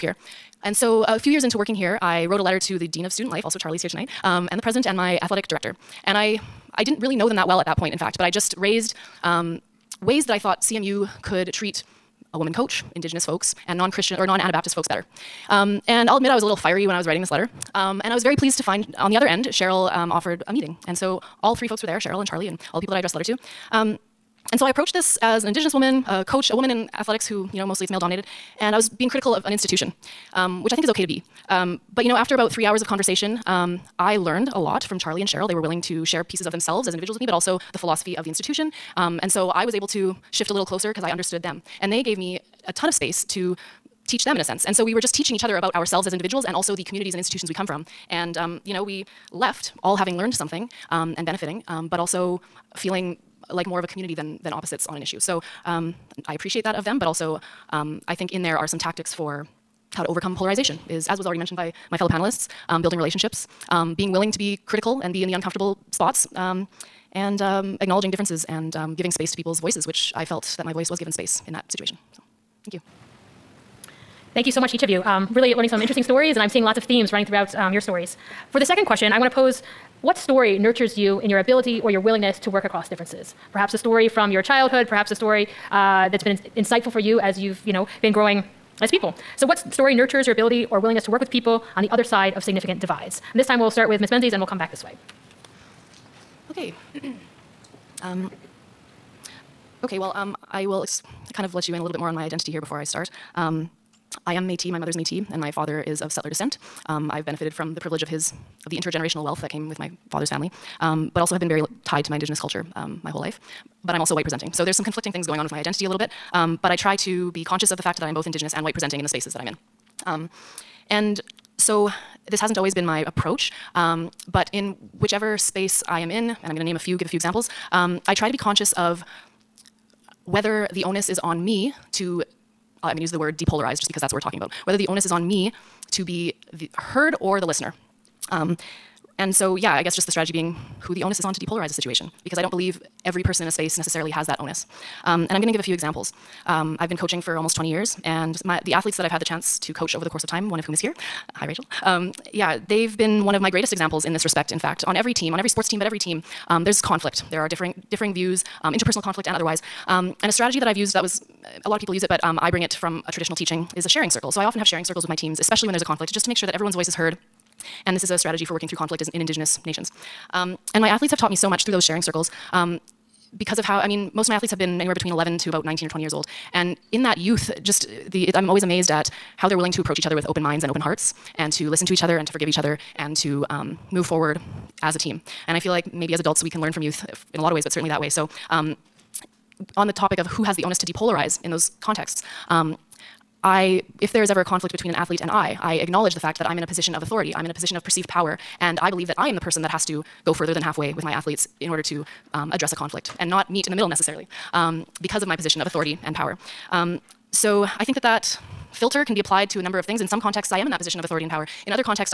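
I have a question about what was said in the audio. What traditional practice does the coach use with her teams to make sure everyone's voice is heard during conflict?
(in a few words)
sharing circle.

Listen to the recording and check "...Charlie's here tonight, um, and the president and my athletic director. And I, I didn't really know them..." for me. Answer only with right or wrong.
right.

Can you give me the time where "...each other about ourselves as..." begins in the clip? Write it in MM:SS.
00:45.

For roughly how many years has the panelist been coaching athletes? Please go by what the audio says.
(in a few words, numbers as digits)
almost 20 years.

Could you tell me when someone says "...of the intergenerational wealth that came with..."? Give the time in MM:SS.
01:48.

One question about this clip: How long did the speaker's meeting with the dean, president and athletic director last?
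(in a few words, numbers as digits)
3 hours.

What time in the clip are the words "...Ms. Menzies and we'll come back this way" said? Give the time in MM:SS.
01:34.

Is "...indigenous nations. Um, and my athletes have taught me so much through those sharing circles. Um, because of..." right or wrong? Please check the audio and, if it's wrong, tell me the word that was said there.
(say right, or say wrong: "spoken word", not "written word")
right.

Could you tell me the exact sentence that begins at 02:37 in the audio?
There are differing, differing views, um, interpersonal conflict and otherwise.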